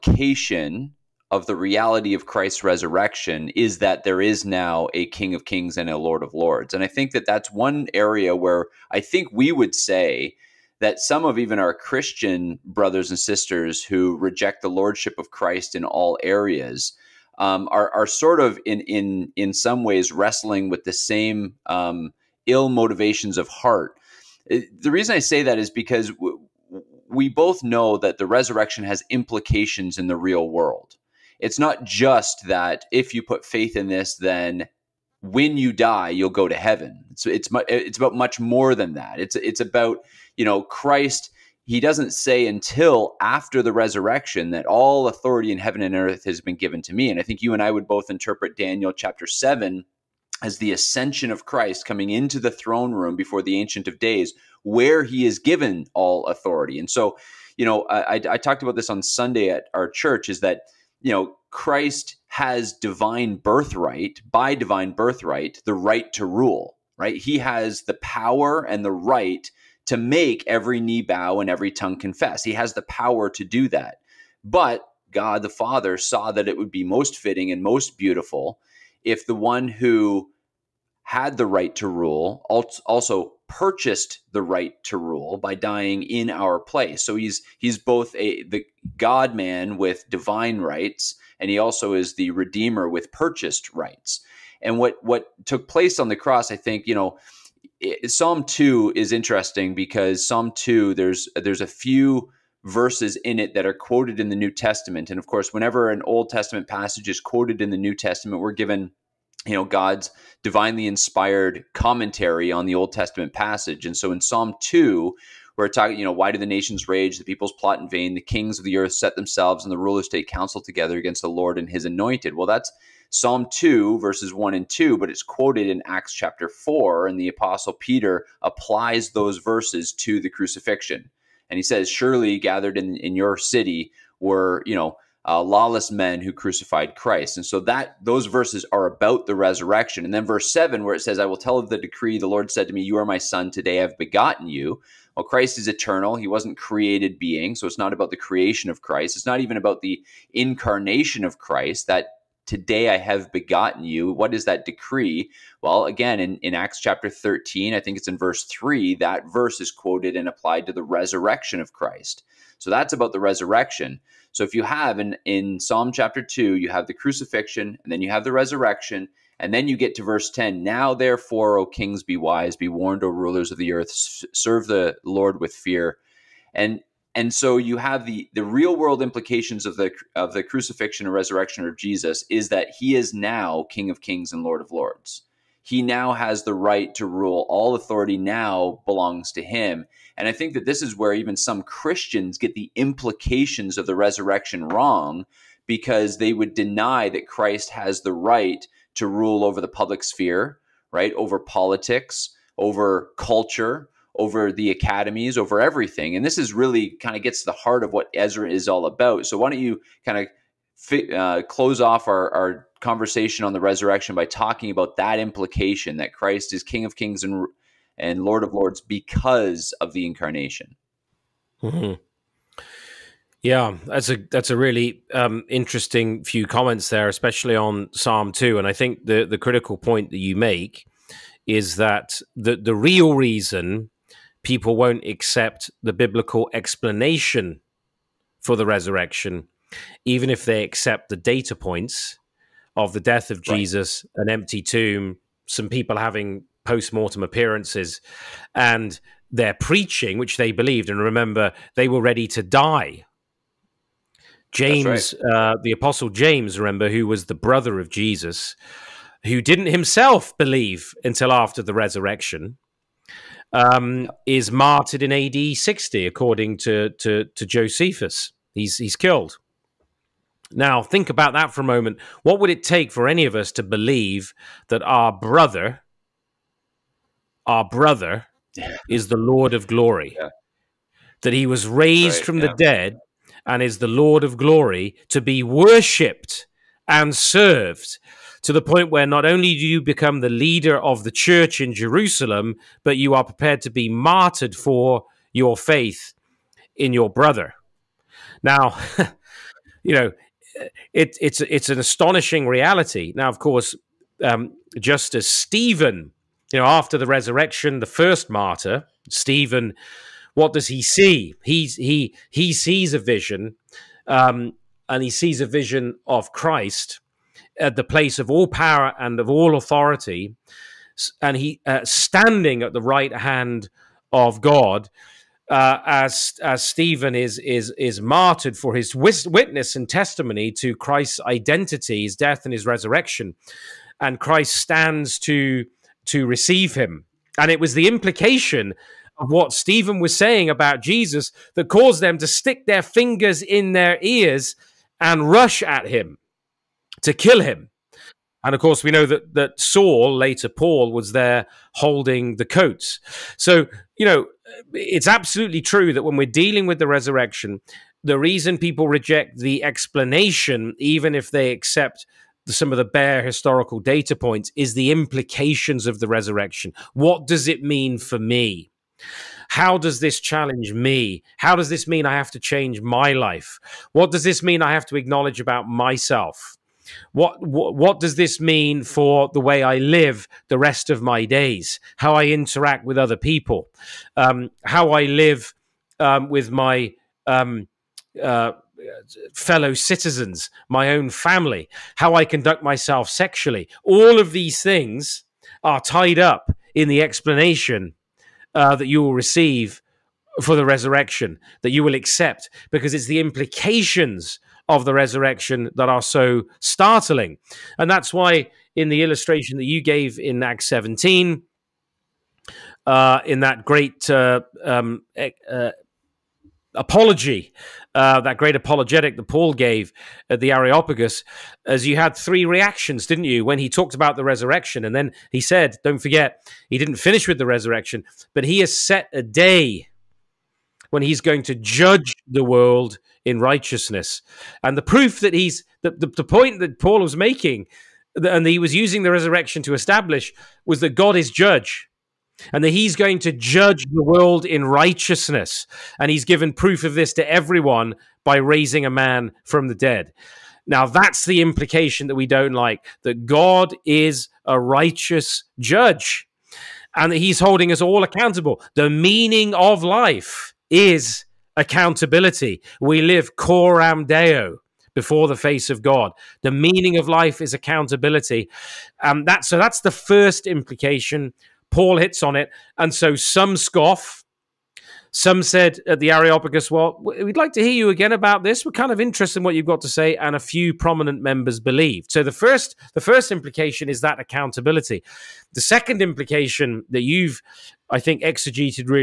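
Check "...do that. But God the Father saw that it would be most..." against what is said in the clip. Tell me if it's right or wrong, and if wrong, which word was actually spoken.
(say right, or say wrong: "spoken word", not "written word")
right.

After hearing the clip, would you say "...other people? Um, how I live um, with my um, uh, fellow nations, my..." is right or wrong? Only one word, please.
wrong.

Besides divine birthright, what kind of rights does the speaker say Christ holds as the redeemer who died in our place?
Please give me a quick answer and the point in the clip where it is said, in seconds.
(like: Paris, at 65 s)
Purchased rights, at 93 s.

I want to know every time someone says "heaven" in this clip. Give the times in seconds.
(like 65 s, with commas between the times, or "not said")
36 s, 45 s.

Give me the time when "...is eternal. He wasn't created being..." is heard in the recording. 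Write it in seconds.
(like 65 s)
145 s.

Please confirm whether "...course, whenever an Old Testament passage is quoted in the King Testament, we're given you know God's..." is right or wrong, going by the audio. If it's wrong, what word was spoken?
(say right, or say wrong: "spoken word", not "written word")
wrong: "New", not "King".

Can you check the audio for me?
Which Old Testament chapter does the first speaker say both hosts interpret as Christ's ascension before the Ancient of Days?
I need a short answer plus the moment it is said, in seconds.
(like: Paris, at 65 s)
Daniel chapter 7, at 48 s.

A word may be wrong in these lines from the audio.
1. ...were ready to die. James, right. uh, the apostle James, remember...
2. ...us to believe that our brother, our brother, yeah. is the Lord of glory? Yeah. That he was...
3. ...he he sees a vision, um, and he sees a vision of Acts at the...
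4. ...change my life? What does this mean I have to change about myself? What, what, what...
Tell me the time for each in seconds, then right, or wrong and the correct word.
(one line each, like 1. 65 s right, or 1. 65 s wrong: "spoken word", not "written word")
1. 251 s right
2. 273 s right
3. 311 s wrong: "Christ", not "Acts"
4. 372 s wrong: "acknowledge", not "change".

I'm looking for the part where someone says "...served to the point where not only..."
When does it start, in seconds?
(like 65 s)
287 s.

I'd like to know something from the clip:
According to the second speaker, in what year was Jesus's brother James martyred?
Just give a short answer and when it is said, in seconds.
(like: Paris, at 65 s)
AD 60, at 265 s.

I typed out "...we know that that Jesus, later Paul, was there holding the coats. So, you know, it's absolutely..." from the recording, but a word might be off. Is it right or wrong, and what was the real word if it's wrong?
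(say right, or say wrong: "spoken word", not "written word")
wrong: "Saul", not "Jesus".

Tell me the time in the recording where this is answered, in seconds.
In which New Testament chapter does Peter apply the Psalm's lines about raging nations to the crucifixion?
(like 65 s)
125 s.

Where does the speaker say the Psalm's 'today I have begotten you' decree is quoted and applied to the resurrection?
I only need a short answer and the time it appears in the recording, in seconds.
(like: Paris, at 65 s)
Acts chapter 13, at 156 s.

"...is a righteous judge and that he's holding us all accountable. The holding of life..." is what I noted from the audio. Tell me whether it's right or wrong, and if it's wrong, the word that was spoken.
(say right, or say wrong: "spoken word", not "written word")
wrong: "meaning", not "holding".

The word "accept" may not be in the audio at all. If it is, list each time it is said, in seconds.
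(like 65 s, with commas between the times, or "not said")
235 s, 240 s, 361 s, 401 s.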